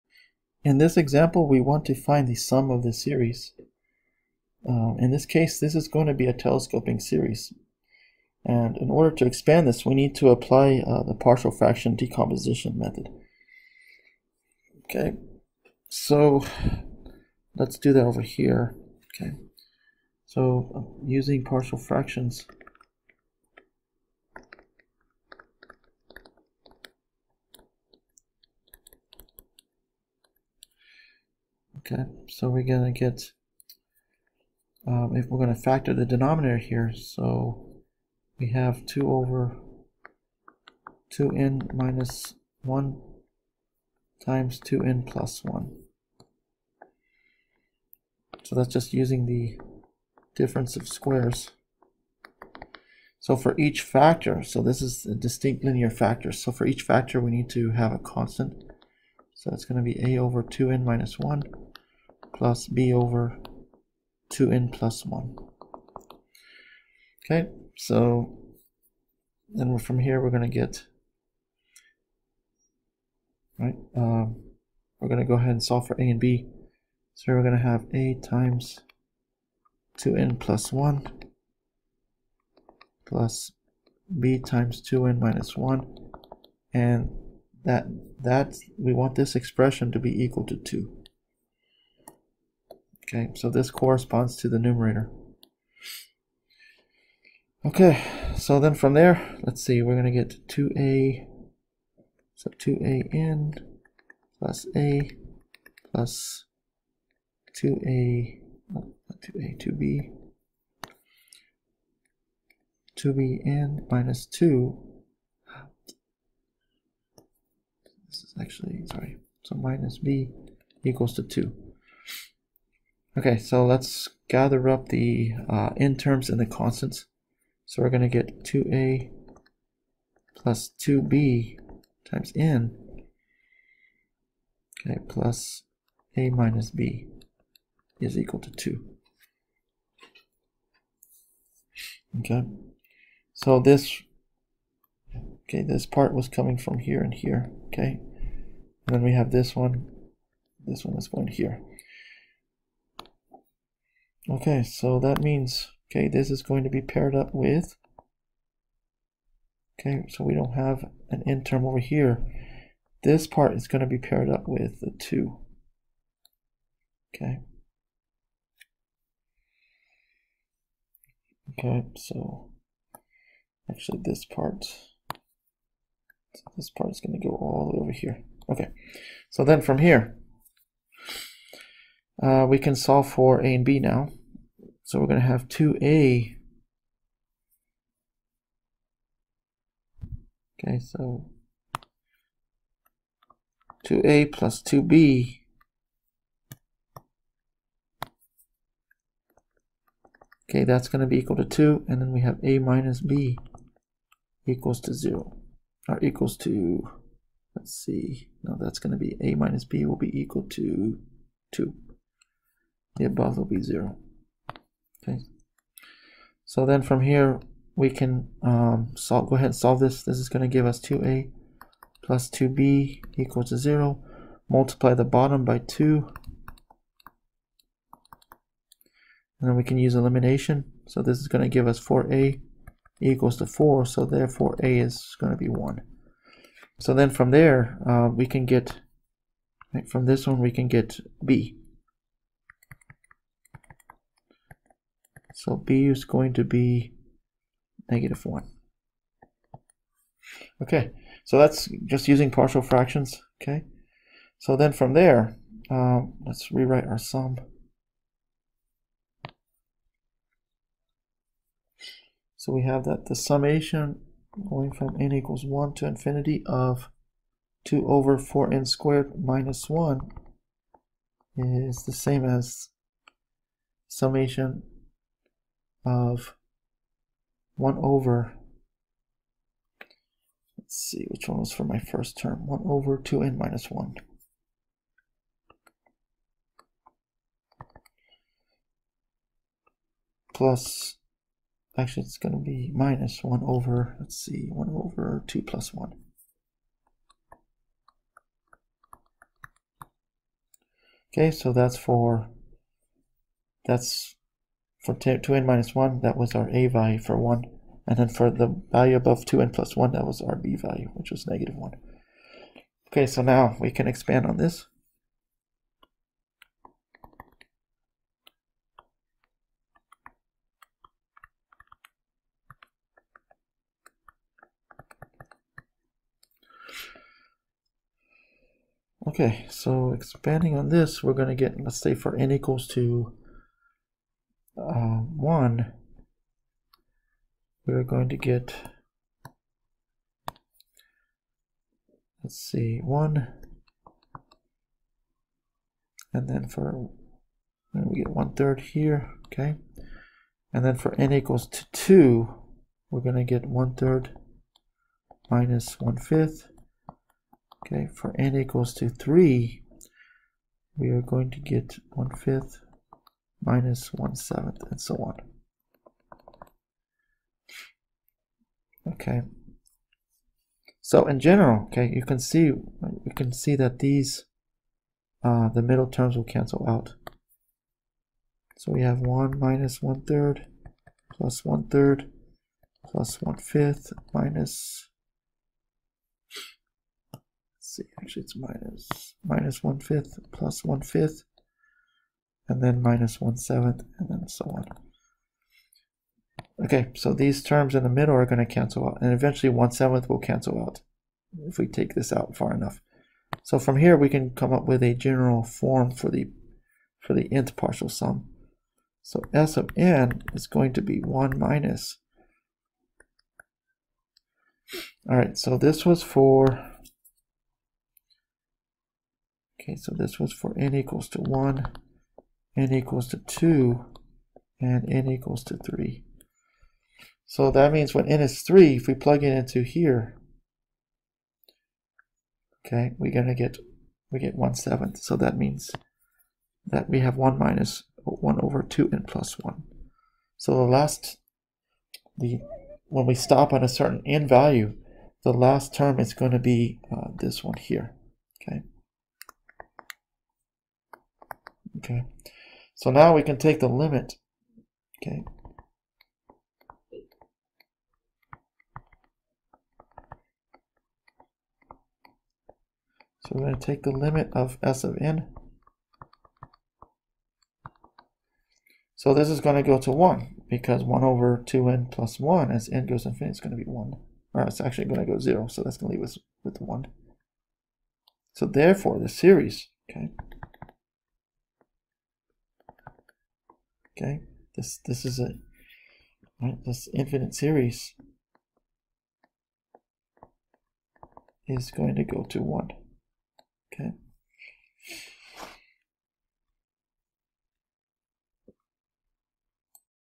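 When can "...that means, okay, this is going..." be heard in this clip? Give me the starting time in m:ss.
2:34.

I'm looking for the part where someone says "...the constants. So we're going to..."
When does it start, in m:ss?
2:06.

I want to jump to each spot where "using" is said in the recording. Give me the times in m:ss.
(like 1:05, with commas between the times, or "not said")
0:21, 0:48, 4:12.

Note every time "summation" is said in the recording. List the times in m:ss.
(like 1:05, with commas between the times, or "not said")
4:23, 4:33.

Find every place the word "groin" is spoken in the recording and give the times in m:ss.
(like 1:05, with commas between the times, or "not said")
not said.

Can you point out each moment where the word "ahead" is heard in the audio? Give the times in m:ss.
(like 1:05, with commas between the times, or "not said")
1:15, 3:39.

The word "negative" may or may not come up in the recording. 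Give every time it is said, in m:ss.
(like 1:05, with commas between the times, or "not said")
4:07, 5:11.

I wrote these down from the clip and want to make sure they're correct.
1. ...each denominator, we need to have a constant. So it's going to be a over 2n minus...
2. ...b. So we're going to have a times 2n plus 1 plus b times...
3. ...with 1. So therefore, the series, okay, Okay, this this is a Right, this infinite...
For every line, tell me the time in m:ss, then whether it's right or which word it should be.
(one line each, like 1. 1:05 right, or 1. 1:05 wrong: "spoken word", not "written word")
1. 0:56 wrong: "factor", not "denominator"
2. 1:16 right
3. 7:56 right.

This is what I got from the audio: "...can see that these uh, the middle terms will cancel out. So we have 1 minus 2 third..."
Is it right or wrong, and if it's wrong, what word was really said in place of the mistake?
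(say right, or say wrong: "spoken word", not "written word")
wrong: "1", not "2".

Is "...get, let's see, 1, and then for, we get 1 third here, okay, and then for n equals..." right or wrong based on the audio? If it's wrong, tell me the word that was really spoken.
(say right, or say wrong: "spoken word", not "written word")
right.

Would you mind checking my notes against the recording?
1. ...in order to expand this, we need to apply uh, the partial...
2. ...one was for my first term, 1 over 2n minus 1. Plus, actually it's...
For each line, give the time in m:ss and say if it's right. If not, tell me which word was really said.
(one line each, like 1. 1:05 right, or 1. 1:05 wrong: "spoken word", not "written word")
1. 0:08 right
2. 4:41 right.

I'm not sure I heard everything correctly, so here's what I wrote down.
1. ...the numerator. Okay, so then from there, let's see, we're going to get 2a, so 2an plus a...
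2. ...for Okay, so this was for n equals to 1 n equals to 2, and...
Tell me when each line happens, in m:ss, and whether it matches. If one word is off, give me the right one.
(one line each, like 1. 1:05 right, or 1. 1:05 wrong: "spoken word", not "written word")
1. 1:34 right
2. 6:56 right.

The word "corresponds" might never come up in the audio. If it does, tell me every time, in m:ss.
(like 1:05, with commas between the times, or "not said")
1:33.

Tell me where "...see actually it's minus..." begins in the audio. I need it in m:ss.
6:27.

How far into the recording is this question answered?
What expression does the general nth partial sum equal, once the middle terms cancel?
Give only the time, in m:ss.
7:17.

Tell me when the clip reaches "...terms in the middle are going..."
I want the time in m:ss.
6:37.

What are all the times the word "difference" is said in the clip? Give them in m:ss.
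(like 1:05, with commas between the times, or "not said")
0:50.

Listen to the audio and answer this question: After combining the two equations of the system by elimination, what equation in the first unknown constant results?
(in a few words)
4a = 4.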